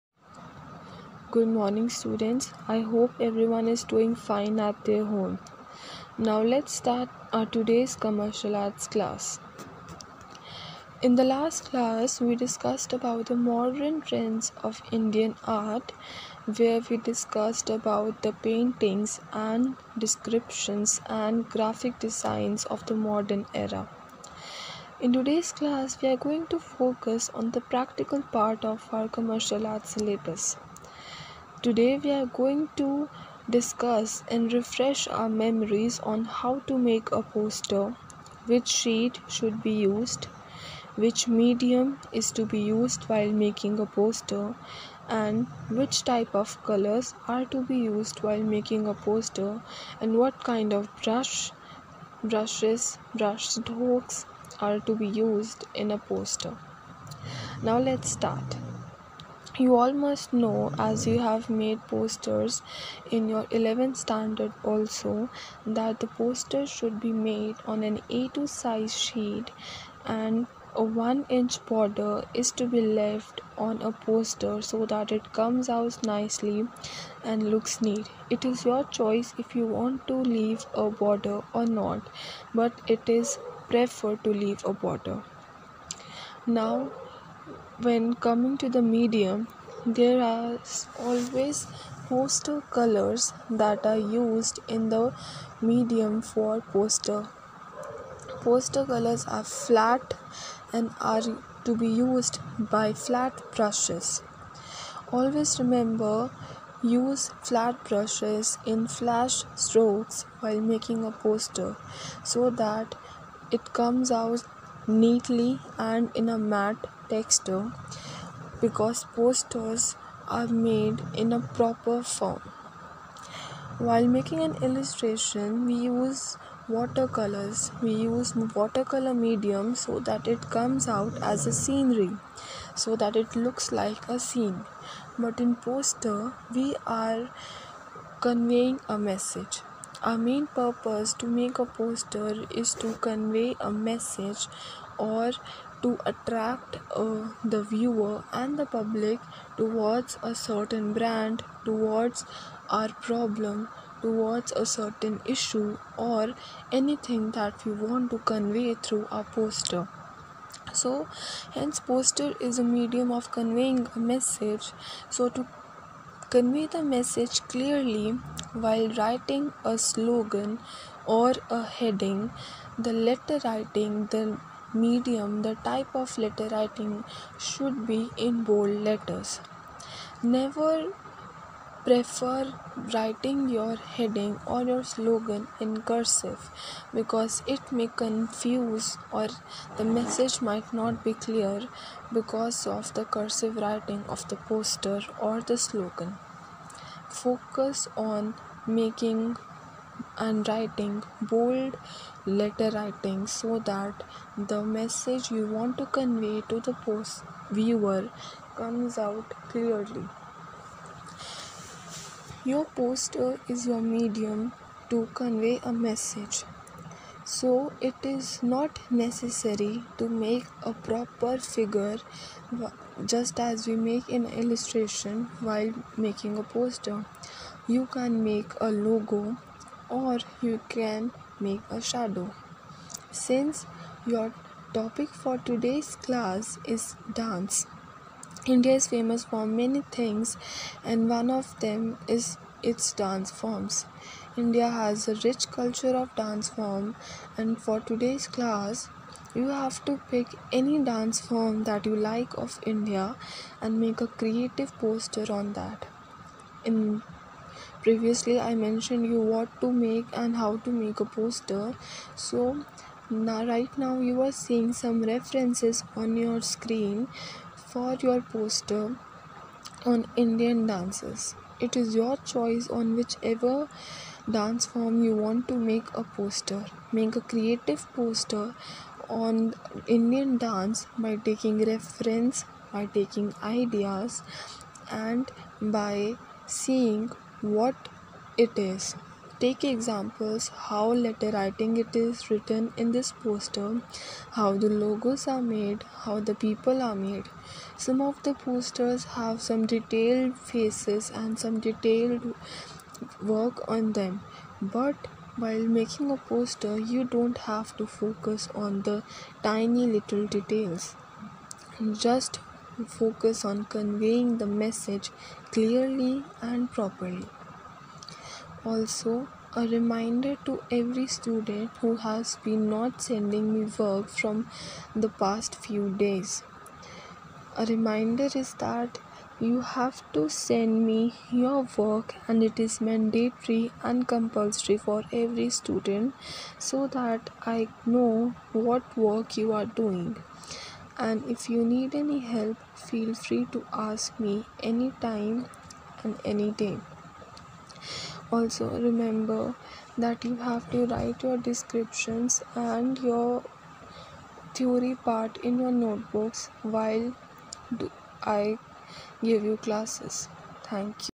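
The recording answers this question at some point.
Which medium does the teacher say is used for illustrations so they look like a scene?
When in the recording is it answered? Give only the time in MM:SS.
02:06.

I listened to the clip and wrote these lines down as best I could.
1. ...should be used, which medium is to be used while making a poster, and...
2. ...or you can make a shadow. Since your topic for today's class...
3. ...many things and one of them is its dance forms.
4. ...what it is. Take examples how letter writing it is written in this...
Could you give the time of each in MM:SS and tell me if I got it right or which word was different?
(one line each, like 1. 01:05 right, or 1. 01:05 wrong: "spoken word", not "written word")
1. 00:39 right
2. 03:49 right
3. 03:59 right
4. 04:47 right.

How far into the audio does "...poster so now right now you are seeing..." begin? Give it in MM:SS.
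04:21.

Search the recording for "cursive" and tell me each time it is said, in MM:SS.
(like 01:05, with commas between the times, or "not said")
03:05, 03:13.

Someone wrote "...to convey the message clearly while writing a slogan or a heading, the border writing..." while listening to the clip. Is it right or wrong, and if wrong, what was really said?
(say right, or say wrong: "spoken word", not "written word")
wrong: "letter", not "border".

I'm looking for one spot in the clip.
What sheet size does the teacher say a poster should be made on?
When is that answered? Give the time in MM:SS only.
01:08.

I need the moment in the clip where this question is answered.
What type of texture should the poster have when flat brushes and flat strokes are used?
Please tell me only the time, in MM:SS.
01:56.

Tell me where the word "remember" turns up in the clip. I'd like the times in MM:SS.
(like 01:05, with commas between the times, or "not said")
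01:45, 05:48.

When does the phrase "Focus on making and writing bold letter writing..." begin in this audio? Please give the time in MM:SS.
03:17.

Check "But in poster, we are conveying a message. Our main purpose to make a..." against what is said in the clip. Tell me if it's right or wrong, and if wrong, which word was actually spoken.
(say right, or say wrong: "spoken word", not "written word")
right.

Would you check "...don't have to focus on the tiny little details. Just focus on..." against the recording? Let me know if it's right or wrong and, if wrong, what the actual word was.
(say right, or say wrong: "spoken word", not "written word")
right.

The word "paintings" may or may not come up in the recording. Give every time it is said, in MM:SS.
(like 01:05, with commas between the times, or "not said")
00:18.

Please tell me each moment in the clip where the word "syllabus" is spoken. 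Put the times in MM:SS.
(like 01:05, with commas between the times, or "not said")
00:29.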